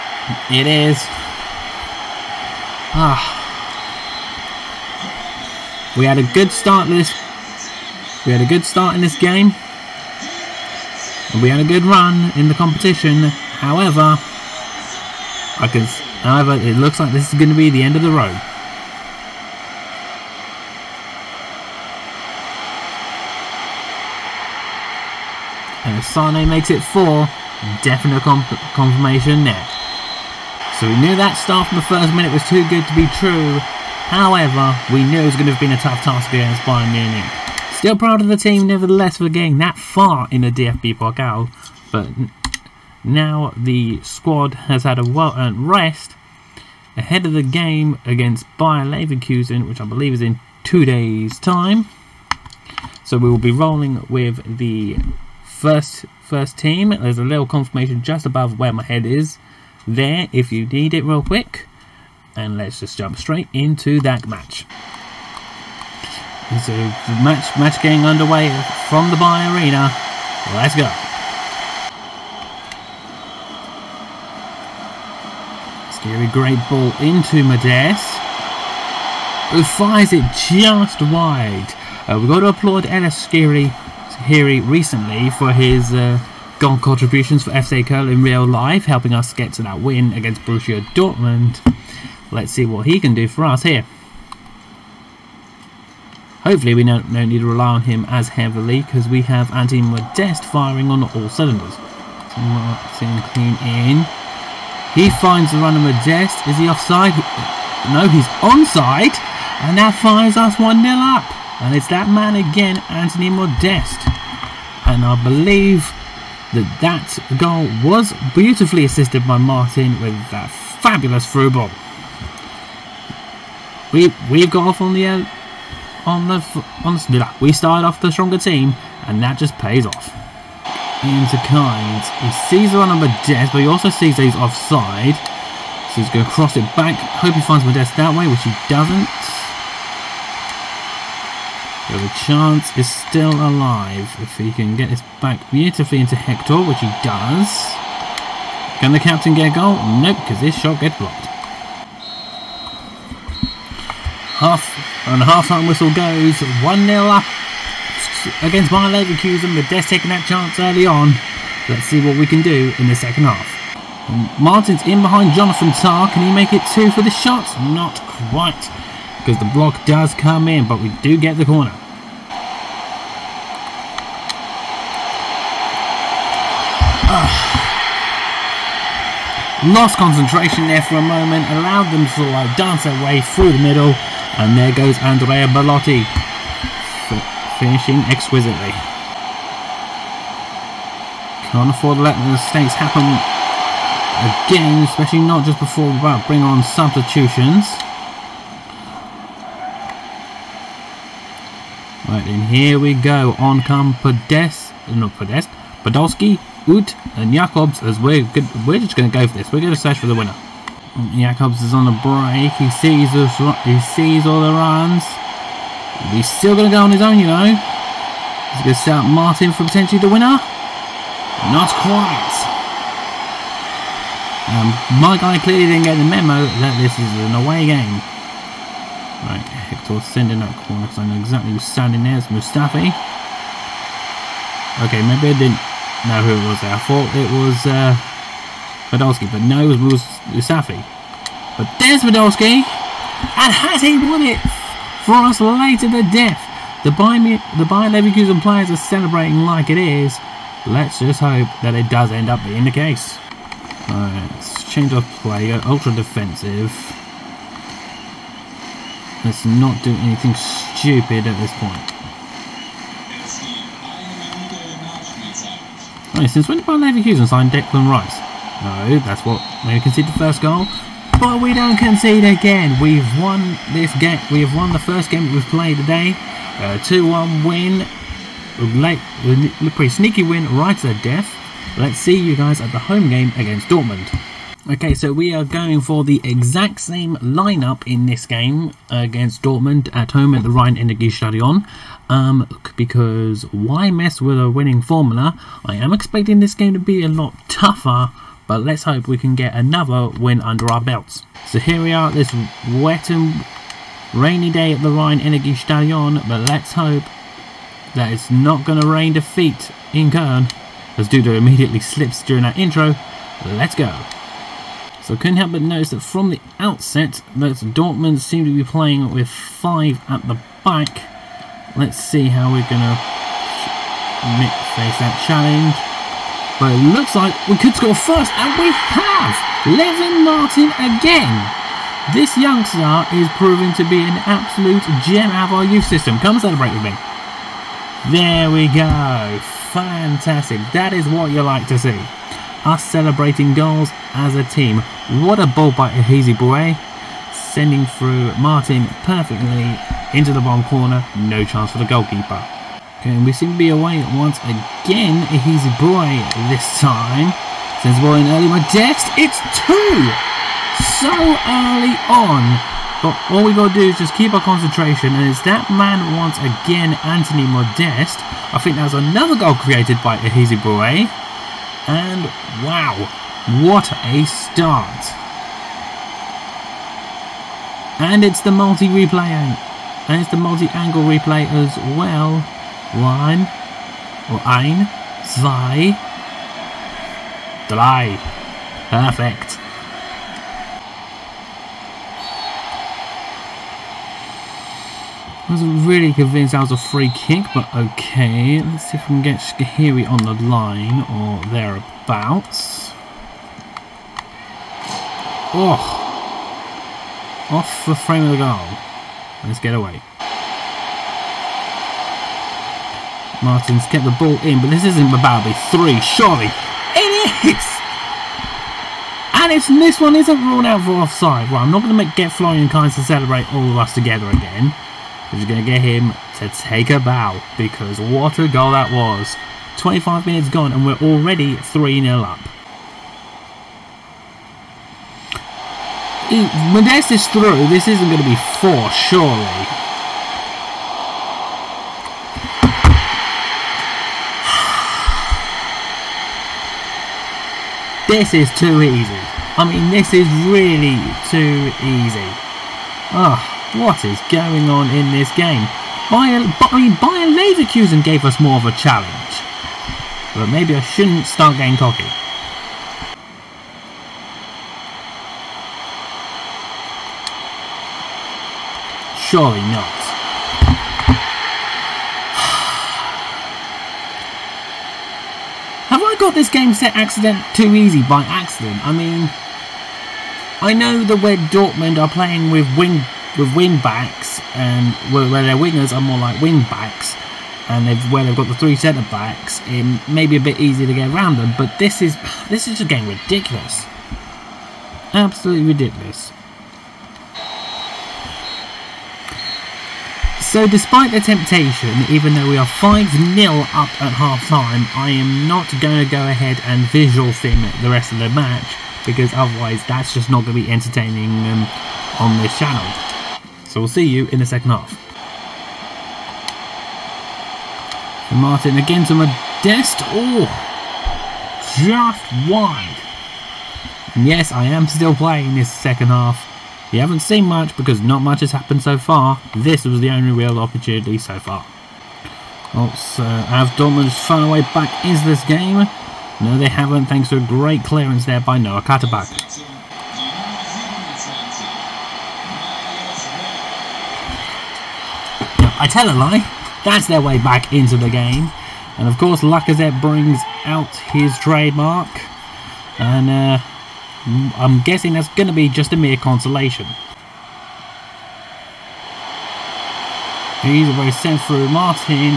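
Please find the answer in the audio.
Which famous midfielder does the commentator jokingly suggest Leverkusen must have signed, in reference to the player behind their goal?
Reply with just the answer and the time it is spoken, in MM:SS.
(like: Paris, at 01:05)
Declan Rice, at 04:27.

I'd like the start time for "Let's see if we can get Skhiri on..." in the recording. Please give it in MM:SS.
06:38.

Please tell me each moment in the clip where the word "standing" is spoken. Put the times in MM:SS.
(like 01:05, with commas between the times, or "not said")
03:51.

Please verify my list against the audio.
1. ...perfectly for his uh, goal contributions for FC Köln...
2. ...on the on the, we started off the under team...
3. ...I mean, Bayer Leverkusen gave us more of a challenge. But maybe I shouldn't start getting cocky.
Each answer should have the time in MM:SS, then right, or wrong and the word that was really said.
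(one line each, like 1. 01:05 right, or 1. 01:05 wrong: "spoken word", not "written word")
1. 01:24 wrong: "recently", not "perfectly"
2. 02:06 wrong: "stronger", not "under"
3. 07:36 right.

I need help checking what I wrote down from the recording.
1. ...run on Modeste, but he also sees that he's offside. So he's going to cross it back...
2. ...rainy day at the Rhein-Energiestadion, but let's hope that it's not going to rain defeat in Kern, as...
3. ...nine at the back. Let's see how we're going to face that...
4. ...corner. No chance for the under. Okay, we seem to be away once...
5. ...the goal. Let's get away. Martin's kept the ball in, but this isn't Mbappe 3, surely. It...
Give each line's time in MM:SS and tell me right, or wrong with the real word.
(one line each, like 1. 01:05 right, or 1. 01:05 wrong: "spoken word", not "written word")
1. 02:12 right
2. 05:04 right
3. 05:19 wrong: "five", not "nine"
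4. 05:50 wrong: "goalkeeper", not "under"
5. 06:48 right.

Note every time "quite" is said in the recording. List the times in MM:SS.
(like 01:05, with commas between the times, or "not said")
02:48, 03:41.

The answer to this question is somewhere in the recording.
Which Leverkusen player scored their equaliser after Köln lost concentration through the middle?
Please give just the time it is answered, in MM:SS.
03:04.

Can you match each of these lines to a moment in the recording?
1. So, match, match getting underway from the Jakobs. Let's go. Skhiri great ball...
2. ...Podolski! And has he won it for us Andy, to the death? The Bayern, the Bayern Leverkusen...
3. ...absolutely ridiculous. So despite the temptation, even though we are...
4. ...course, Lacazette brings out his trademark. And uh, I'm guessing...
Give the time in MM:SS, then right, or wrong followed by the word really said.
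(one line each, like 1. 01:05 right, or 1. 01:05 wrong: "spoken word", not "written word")
1. 01:06 wrong: "BayArena", not "Jakobs"
2. 04:02 wrong: "Later", not "Andy"
3. 08:15 right
4. 09:09 right.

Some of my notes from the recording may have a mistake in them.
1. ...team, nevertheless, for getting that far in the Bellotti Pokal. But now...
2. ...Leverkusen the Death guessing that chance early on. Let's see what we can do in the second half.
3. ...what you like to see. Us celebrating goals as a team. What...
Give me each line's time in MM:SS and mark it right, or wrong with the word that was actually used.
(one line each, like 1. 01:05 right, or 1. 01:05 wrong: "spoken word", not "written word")
1. 00:38 wrong: "DFB", not "Bellotti"
2. 02:38 wrong: "taking", not "guessing"
3. 05:41 right.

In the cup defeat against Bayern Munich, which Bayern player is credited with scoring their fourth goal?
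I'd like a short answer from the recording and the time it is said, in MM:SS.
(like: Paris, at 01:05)
Sane, at 00:26.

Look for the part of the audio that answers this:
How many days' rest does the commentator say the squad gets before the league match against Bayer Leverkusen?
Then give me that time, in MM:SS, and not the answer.
00:50.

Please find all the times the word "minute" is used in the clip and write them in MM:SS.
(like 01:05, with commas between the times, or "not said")
00:32, 07:10.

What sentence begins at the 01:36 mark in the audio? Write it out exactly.
Hopefully we don't, don't need to rely on him as heavily because we have Andy Modeste firing on all cylinders.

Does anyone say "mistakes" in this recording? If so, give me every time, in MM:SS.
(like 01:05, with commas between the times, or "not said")
03:12.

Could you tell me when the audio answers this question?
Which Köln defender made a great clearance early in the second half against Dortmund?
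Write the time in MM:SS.
08:58.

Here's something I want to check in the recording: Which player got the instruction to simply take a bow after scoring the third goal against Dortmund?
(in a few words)
Florian Kainz.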